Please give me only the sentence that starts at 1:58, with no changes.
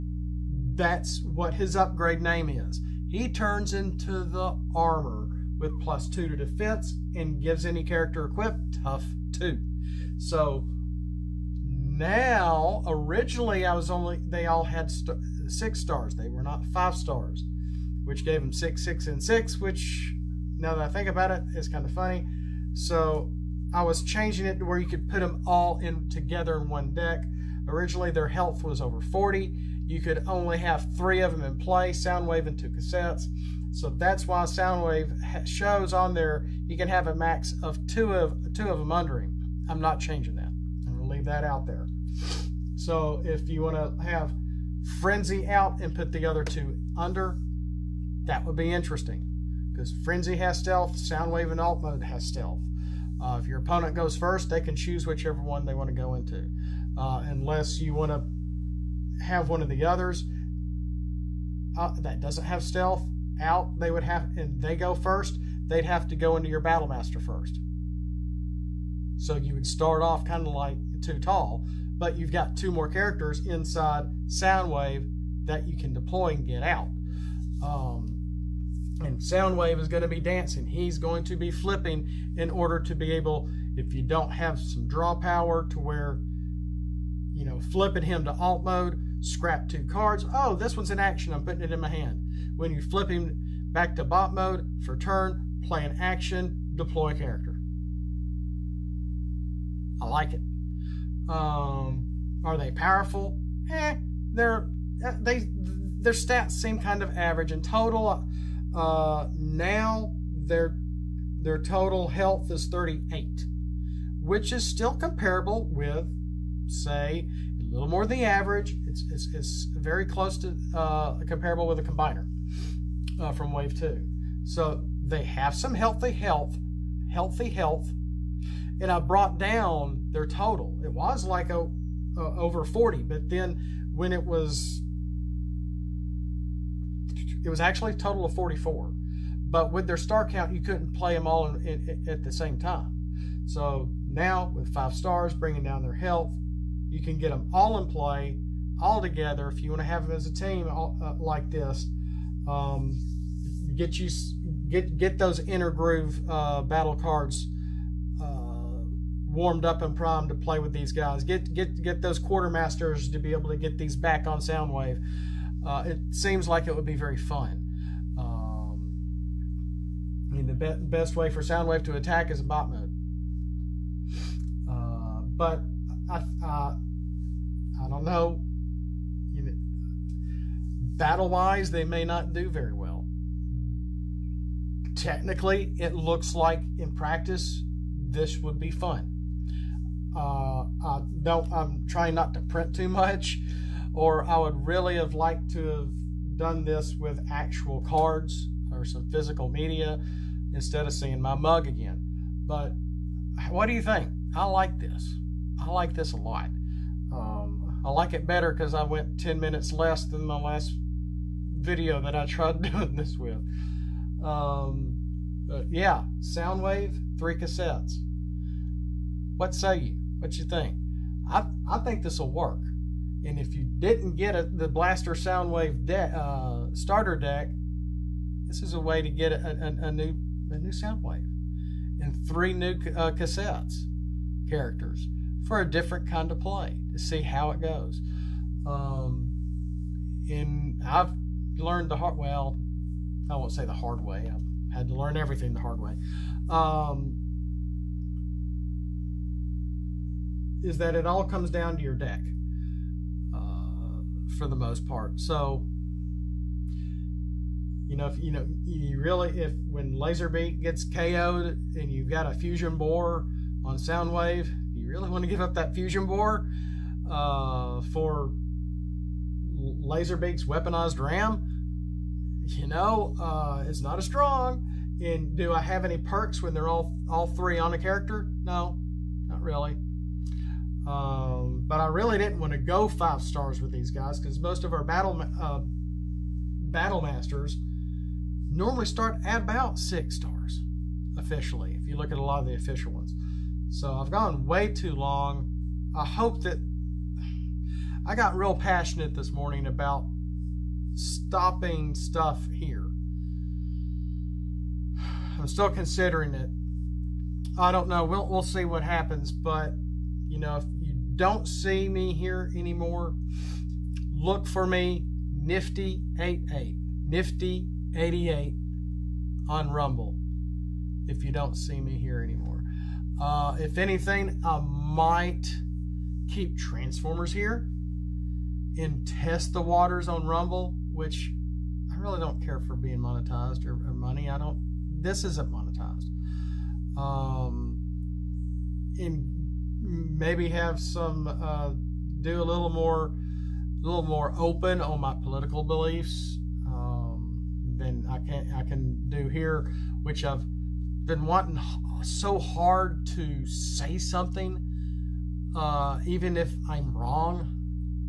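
It's, it's, it's very close to uh, comparable with a combiner uh, from Wave 2.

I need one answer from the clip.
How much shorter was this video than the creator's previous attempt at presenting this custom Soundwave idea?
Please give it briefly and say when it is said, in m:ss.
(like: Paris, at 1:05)
10 minutes, at 3:29.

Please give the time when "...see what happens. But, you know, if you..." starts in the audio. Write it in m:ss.
5:08.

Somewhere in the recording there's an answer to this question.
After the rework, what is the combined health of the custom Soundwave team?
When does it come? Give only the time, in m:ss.
1:52.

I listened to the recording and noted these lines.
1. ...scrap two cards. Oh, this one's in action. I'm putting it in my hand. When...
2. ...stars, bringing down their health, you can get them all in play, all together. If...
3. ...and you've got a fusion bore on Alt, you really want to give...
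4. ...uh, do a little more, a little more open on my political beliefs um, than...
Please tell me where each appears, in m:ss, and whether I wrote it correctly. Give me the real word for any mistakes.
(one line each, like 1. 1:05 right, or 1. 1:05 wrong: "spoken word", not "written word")
1. 1:29 right
2. 2:24 right
3. 4:21 wrong: "Soundwave", not "Alt"
4. 5:41 right.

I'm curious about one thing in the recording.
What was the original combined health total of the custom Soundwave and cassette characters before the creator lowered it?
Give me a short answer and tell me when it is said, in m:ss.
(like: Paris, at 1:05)
44, at 2:18.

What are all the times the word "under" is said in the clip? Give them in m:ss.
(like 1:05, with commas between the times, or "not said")
0:38, 0:46.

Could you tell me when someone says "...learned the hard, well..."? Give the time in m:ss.
4:01.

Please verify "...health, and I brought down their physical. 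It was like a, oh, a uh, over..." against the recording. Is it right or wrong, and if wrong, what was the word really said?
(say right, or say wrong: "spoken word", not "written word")
wrong: "total", not "physical".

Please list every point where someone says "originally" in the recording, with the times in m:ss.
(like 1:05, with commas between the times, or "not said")
0:12, 0:27.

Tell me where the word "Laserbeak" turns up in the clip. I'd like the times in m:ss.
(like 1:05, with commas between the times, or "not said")
4:19, 4:29.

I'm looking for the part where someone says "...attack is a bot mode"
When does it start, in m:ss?
2:51.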